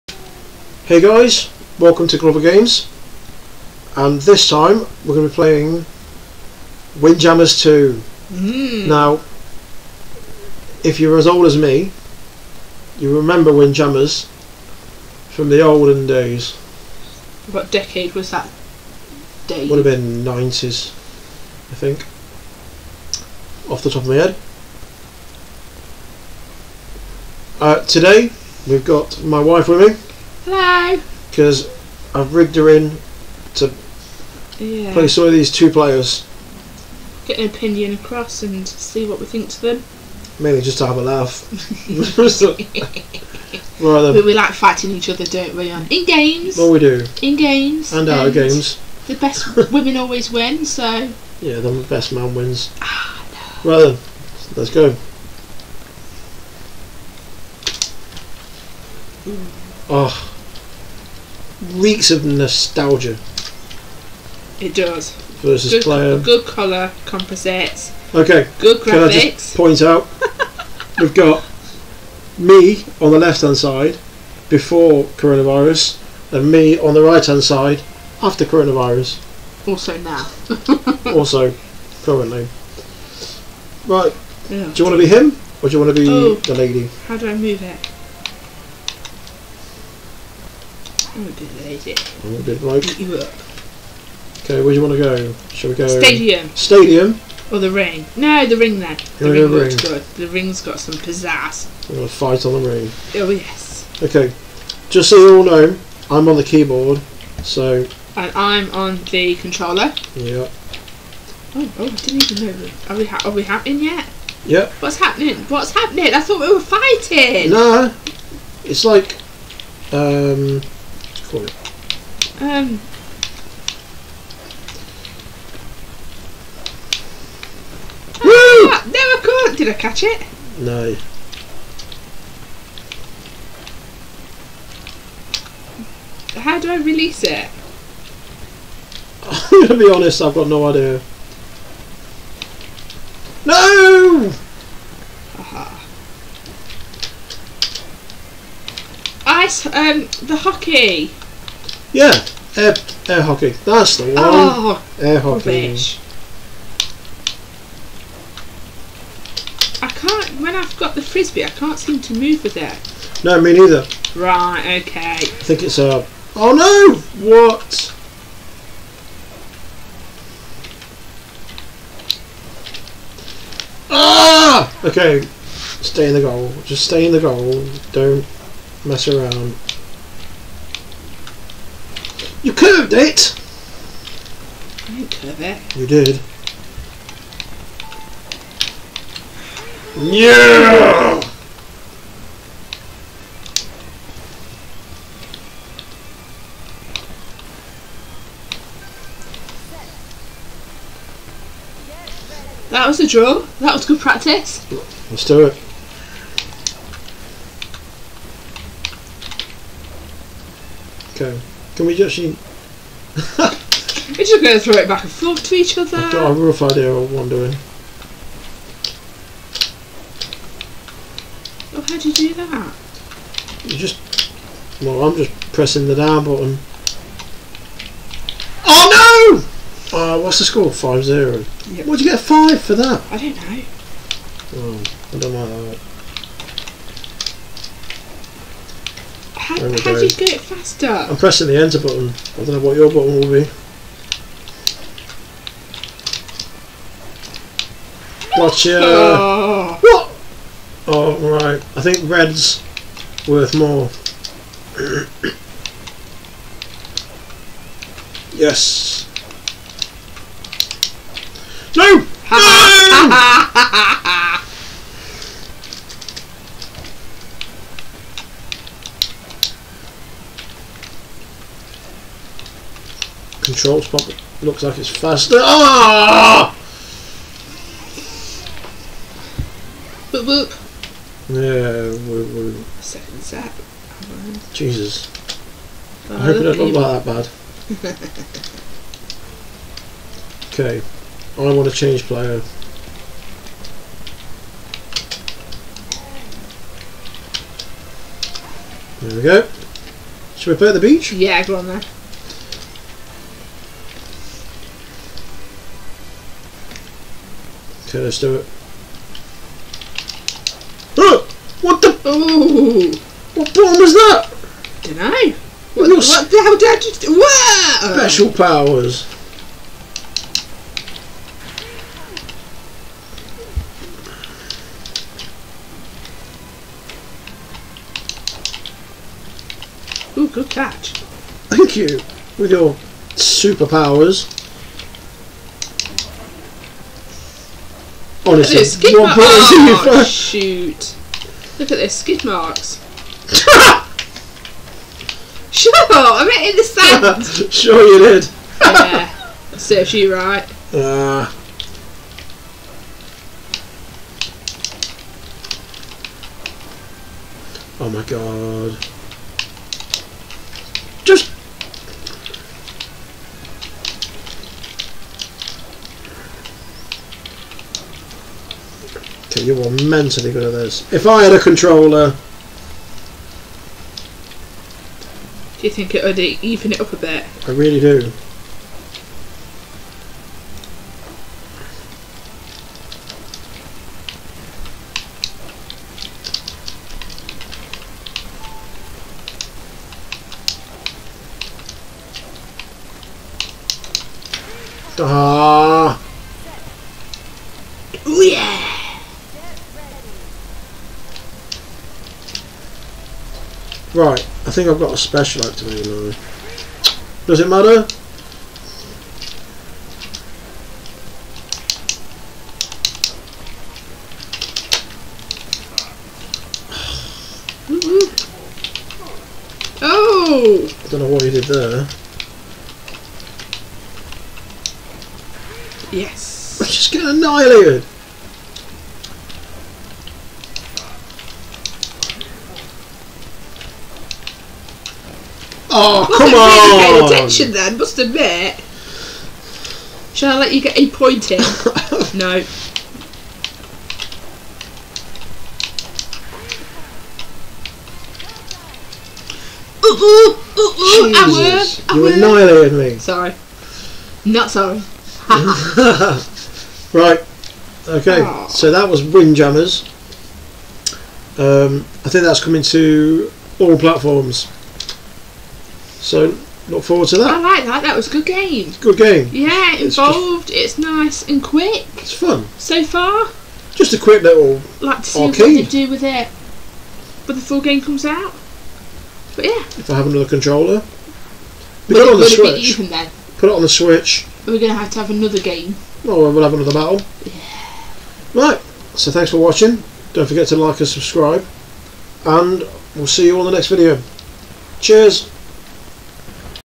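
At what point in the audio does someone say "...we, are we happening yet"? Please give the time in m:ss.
1:52.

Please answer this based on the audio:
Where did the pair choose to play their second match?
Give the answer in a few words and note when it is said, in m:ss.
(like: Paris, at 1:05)
The beach, at 5:00.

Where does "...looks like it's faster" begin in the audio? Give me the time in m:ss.
4:34.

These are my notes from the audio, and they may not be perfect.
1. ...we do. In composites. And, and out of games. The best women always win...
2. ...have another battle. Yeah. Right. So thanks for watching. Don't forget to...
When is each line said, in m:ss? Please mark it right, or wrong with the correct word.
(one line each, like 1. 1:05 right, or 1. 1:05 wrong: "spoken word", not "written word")
1. 0:46 wrong: "games", not "composites"
2. 8:06 right.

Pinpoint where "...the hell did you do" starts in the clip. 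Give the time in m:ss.
5:16.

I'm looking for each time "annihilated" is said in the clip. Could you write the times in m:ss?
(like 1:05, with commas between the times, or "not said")
7:07, 7:32.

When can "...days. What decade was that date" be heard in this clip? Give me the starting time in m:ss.
0:16.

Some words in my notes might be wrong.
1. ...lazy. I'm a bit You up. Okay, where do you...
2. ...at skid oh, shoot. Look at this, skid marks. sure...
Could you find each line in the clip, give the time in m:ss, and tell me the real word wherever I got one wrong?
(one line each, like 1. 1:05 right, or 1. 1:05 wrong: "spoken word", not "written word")
1. 1:31 right
2. 5:38 right.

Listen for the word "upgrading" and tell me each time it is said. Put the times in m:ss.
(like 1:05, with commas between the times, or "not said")
not said.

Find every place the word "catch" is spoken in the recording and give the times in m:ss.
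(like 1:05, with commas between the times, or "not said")
2:09, 5:30.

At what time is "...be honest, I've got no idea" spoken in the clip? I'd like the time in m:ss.
2:19.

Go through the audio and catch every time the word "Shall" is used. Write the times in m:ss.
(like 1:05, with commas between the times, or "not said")
1:35, 7:20.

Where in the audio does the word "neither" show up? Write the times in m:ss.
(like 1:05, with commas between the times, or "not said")
2:43.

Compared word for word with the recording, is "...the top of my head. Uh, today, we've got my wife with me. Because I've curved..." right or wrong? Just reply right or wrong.
wrong.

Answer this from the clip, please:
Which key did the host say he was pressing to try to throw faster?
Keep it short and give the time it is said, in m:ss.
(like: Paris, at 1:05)
Enter, at 4:01.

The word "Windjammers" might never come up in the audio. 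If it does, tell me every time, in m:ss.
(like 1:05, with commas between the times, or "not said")
0:06, 0:13, 7:39.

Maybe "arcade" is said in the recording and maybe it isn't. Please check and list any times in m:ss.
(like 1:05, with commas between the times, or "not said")
7:55.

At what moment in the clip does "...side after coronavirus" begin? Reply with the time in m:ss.
1:17.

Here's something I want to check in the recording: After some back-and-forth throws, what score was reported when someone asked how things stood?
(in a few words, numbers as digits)
5-0.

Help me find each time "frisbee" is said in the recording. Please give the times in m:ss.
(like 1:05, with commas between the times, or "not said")
2:41.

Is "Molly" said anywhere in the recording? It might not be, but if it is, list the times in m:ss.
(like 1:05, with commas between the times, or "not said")
not said.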